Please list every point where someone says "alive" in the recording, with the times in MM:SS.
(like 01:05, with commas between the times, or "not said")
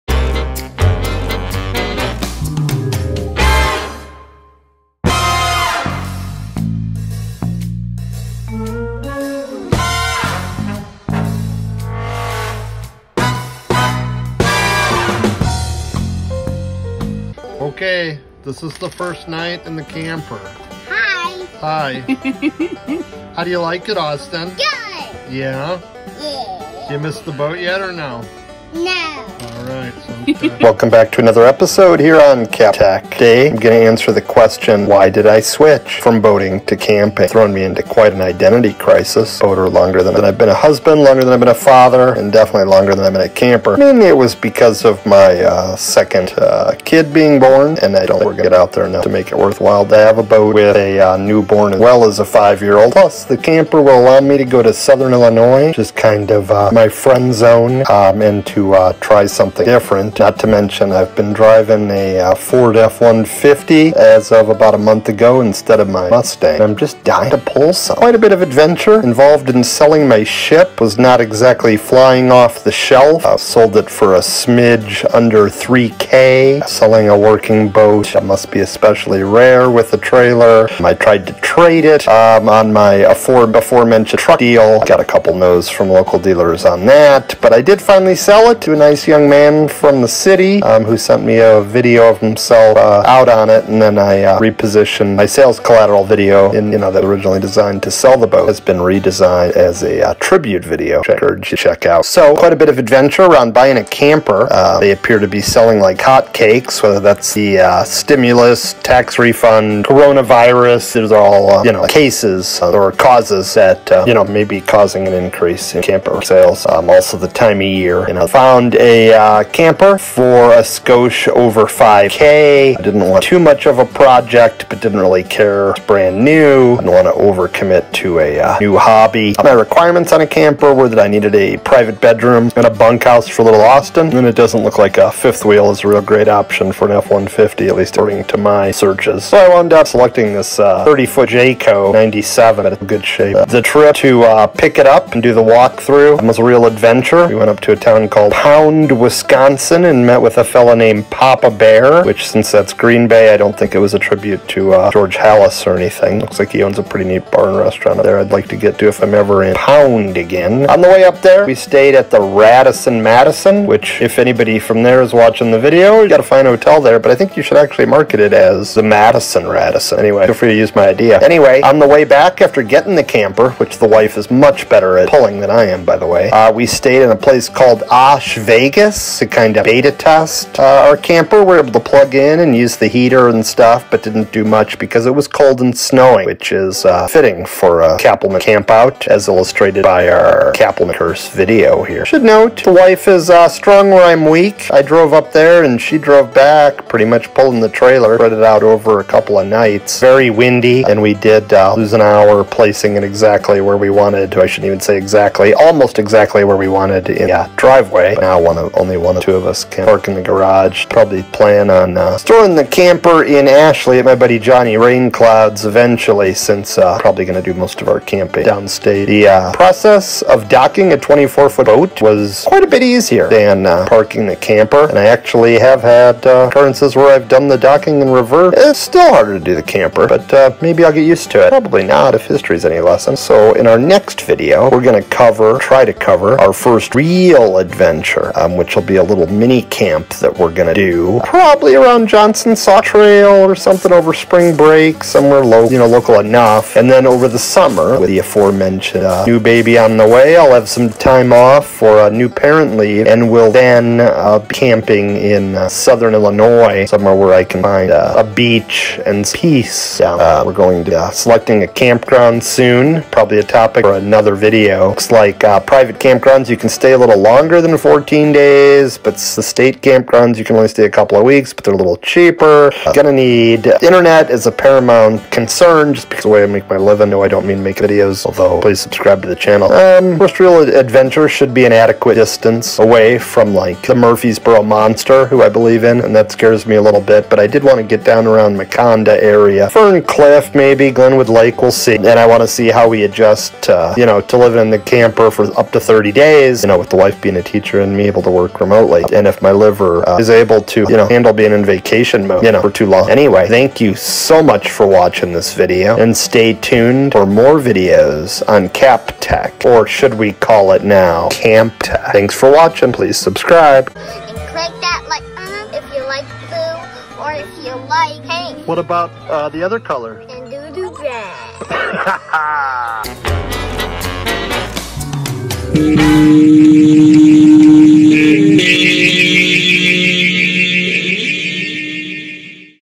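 not said.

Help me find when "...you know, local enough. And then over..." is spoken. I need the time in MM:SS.
04:05.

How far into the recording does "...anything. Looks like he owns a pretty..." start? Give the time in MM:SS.
02:35.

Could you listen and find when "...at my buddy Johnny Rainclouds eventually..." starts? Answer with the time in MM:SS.
03:33.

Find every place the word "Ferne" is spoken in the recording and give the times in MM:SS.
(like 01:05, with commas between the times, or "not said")
04:49.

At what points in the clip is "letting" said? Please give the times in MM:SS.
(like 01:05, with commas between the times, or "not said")
not said.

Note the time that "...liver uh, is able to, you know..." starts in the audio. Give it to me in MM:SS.
04:59.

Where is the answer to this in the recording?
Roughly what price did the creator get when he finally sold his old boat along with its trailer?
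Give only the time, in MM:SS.
01:14.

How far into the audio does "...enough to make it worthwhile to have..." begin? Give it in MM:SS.
00:48.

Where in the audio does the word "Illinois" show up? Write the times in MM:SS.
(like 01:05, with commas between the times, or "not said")
00:55, 04:16.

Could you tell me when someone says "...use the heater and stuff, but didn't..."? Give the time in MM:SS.
03:02.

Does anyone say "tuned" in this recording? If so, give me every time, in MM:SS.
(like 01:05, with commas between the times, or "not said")
05:06.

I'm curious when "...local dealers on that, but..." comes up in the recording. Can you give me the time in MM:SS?
01:25.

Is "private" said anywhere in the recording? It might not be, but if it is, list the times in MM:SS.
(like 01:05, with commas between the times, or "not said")
02:11, 04:25.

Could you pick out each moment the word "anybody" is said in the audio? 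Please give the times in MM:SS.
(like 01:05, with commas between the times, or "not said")
02:44.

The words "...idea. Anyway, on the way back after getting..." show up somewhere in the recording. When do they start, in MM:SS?
02:50.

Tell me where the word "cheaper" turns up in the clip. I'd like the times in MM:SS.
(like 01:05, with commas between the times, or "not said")
04:31.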